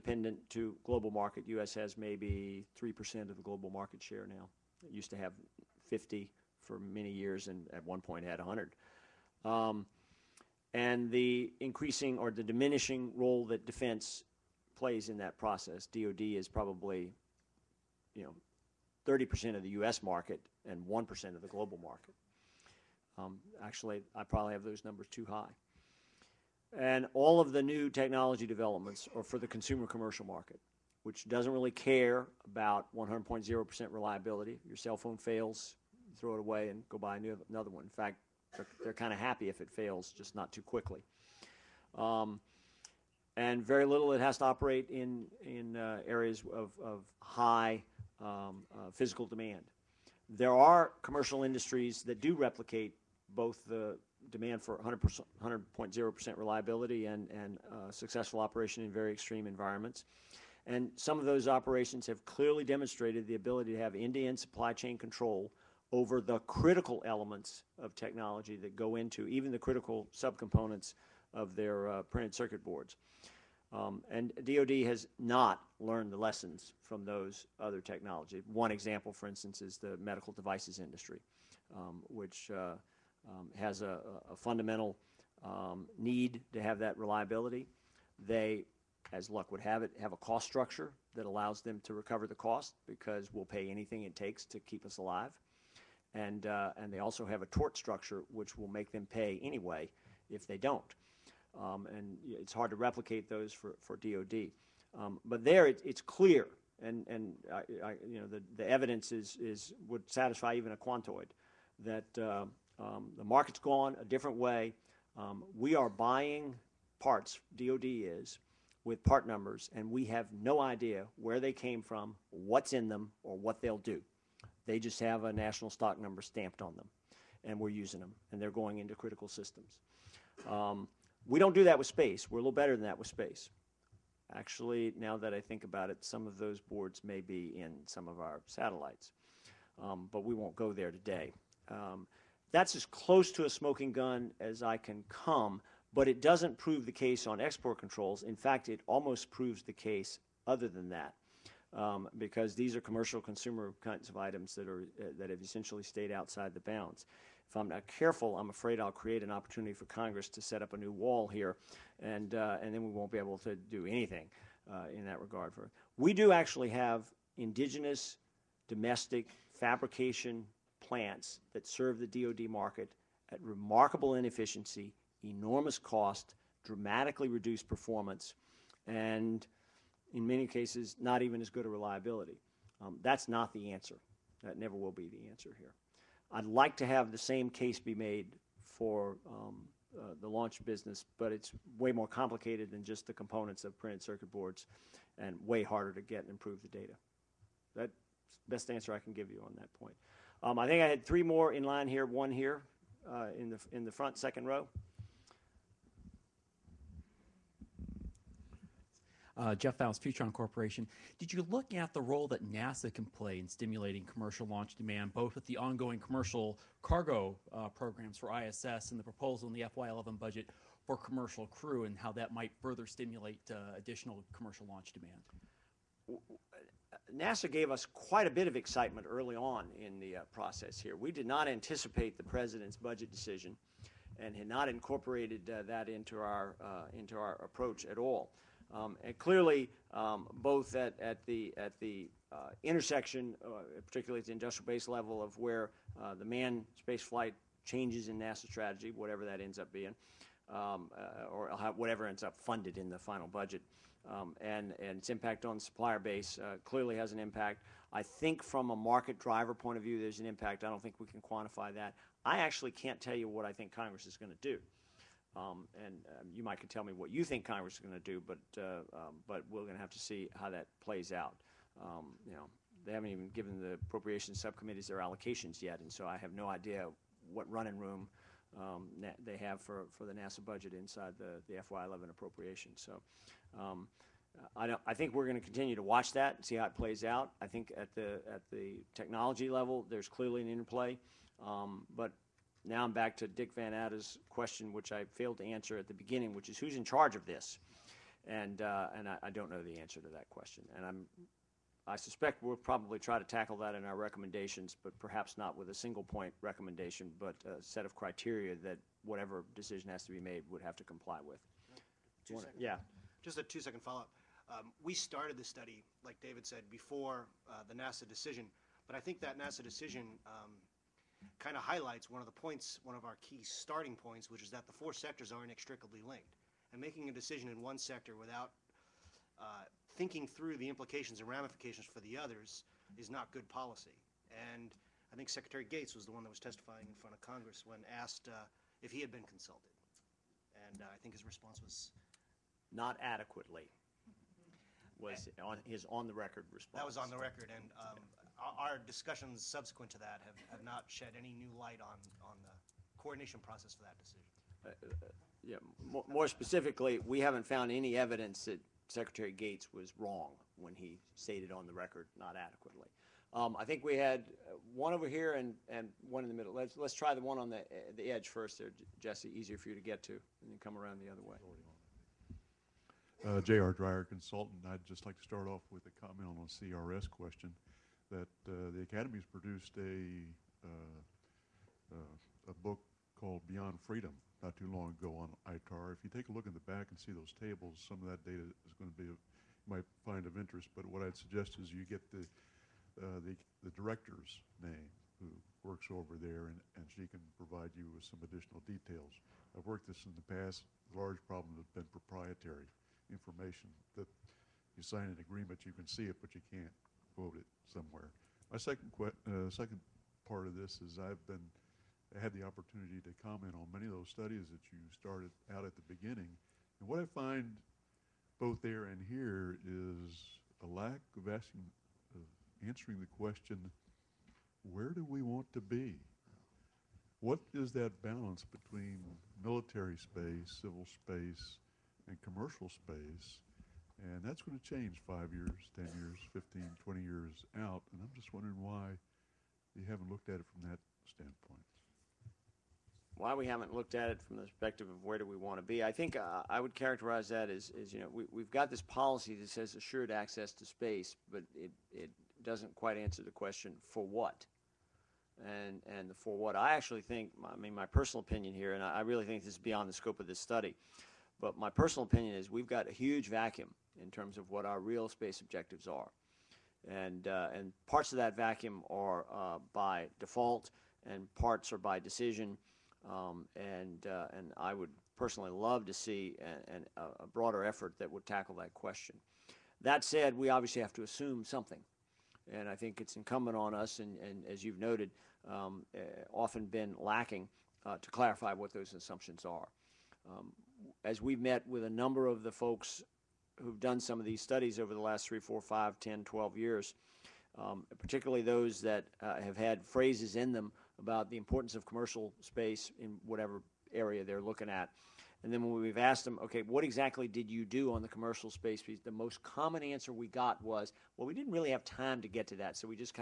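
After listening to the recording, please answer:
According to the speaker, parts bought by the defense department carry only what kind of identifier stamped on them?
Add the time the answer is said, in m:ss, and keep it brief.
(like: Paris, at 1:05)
national stock number, at 2:05.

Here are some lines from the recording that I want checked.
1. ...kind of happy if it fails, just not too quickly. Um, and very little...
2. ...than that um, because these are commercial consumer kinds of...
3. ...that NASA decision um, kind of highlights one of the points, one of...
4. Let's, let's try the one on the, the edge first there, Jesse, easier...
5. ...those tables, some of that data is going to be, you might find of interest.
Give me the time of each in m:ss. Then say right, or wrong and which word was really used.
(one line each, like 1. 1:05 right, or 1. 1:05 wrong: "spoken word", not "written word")
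1. 0:38 right
2. 2:30 right
3. 5:19 right
4. 6:06 right
5. 6:27 right.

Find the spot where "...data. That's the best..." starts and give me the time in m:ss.
3:16.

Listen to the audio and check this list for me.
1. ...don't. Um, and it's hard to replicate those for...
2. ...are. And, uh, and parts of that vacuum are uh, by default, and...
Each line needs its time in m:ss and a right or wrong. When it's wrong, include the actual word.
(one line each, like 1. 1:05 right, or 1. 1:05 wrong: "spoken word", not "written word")
1. 1:40 right
2. 7:45 right.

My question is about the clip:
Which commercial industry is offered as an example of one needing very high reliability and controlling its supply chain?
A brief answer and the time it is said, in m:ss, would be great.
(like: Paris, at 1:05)
medical devices, at 1:19.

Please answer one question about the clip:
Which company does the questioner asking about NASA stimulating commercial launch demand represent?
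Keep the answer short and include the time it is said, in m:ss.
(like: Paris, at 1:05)
Futron Corporation, at 3:30.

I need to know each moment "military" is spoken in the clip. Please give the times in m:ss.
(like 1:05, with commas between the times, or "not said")
7:09.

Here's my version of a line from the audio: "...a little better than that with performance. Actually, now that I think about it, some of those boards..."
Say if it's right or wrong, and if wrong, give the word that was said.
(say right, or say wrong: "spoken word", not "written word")
wrong: "space", not "performance".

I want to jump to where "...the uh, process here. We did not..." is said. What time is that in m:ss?
3:49.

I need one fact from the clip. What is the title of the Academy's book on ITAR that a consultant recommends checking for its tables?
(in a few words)
Beyond Freedom.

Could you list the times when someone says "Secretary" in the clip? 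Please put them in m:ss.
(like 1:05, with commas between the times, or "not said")
5:35, 5:58.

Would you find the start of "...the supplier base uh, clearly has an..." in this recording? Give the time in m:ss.
4:15.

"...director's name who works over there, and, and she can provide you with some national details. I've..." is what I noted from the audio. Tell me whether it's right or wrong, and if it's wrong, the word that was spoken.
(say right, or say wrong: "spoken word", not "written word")
wrong: "additional", not "national".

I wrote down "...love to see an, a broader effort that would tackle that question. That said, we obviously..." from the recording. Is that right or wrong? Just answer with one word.
right.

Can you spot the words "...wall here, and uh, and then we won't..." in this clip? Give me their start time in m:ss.
2:40.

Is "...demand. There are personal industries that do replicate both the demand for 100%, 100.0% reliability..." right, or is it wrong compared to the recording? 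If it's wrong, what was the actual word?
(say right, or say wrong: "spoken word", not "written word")
wrong: "commercial", not "personal".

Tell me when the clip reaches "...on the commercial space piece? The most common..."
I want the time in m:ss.
8:27.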